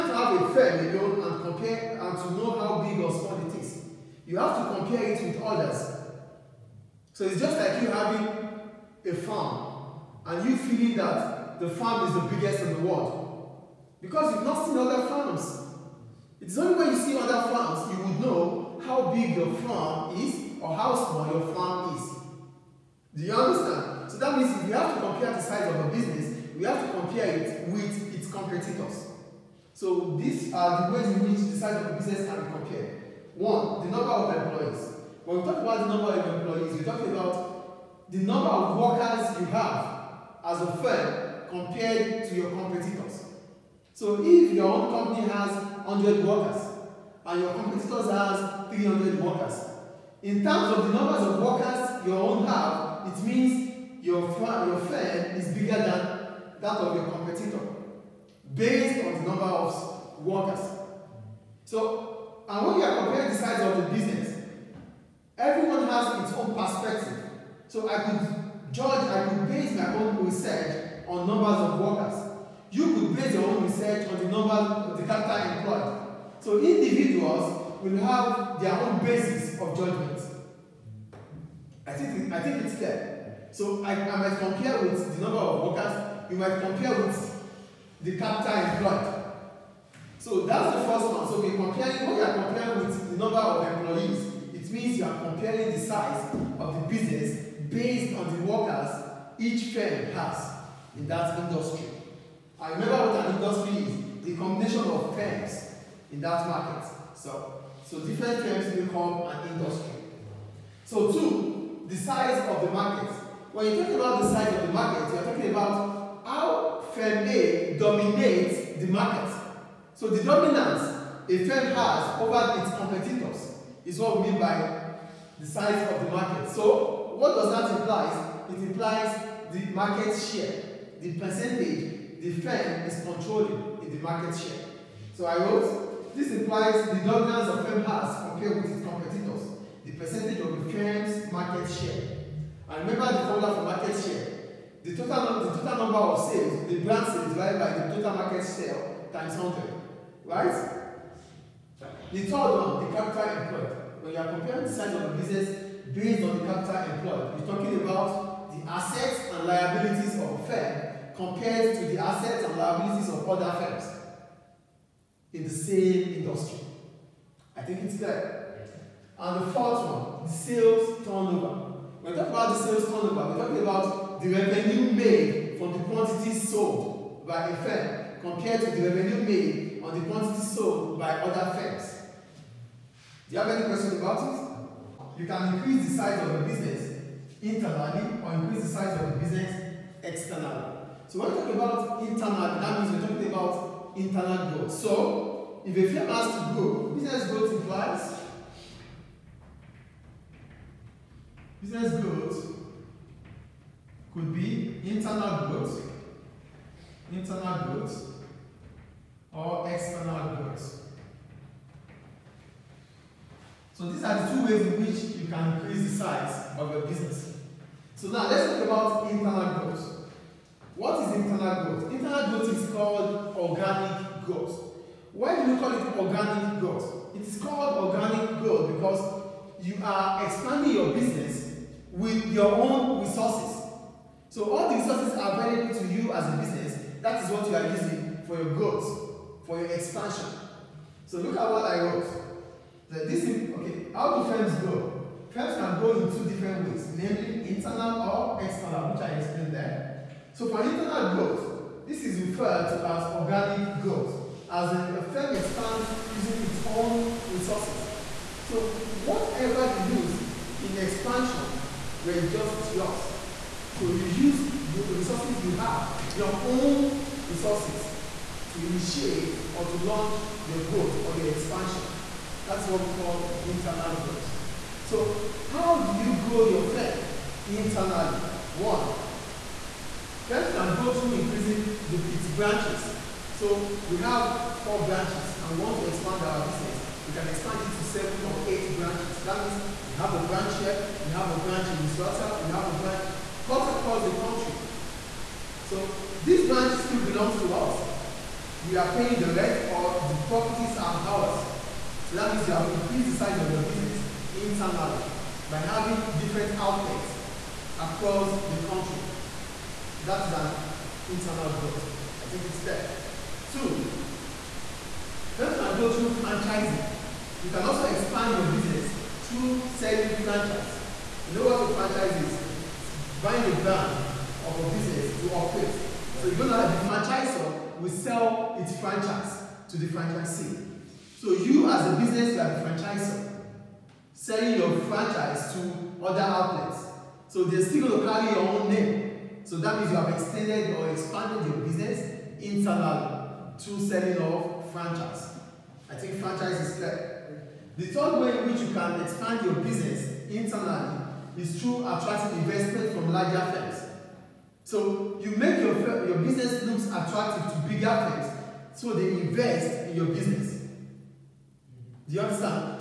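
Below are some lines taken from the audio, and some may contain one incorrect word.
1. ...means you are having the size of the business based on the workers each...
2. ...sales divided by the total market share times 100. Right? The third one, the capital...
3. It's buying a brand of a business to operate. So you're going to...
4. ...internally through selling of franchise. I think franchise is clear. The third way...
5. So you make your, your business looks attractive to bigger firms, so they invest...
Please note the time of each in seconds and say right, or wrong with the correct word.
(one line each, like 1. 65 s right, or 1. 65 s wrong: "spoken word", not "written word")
1. 94 s wrong: "comparing", not "having"
2. 147 s right
3. 322 s right
4. 342 s right
5. 354 s right.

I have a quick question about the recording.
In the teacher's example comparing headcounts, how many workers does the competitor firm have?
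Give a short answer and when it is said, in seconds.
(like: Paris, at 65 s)
300, at 48 s.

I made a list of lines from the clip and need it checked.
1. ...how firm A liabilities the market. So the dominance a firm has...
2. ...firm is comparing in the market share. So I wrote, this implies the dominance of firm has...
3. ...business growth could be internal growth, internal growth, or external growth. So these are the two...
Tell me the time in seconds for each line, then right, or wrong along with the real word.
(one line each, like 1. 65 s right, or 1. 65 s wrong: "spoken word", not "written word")
1. 116 s wrong: "dominates", not "liabilities"
2. 132 s wrong: "controlling", not "comparing"
3. 201 s right.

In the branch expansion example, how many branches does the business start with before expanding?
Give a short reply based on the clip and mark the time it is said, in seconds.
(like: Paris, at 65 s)
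Four, at 284 s.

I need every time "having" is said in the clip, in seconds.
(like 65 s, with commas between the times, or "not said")
7 s, 305 s.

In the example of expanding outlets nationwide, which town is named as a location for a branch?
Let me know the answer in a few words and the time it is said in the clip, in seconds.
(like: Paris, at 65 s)
Misrata, at 291 s.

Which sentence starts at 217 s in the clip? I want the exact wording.
So now let's talk about internal growth.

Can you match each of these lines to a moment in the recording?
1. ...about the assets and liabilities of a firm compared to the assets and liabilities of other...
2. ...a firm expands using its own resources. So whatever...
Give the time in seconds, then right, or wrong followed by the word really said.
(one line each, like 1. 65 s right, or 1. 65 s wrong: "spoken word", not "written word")
1. 157 s right
2. 254 s right.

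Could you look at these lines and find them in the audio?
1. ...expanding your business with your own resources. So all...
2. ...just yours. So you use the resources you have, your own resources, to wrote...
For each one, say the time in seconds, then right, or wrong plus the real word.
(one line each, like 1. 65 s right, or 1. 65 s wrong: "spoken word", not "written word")
1. 230 s right
2. 262 s wrong: "initiate", not "wrote".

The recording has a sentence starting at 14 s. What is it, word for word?
Because you've not seen other farms.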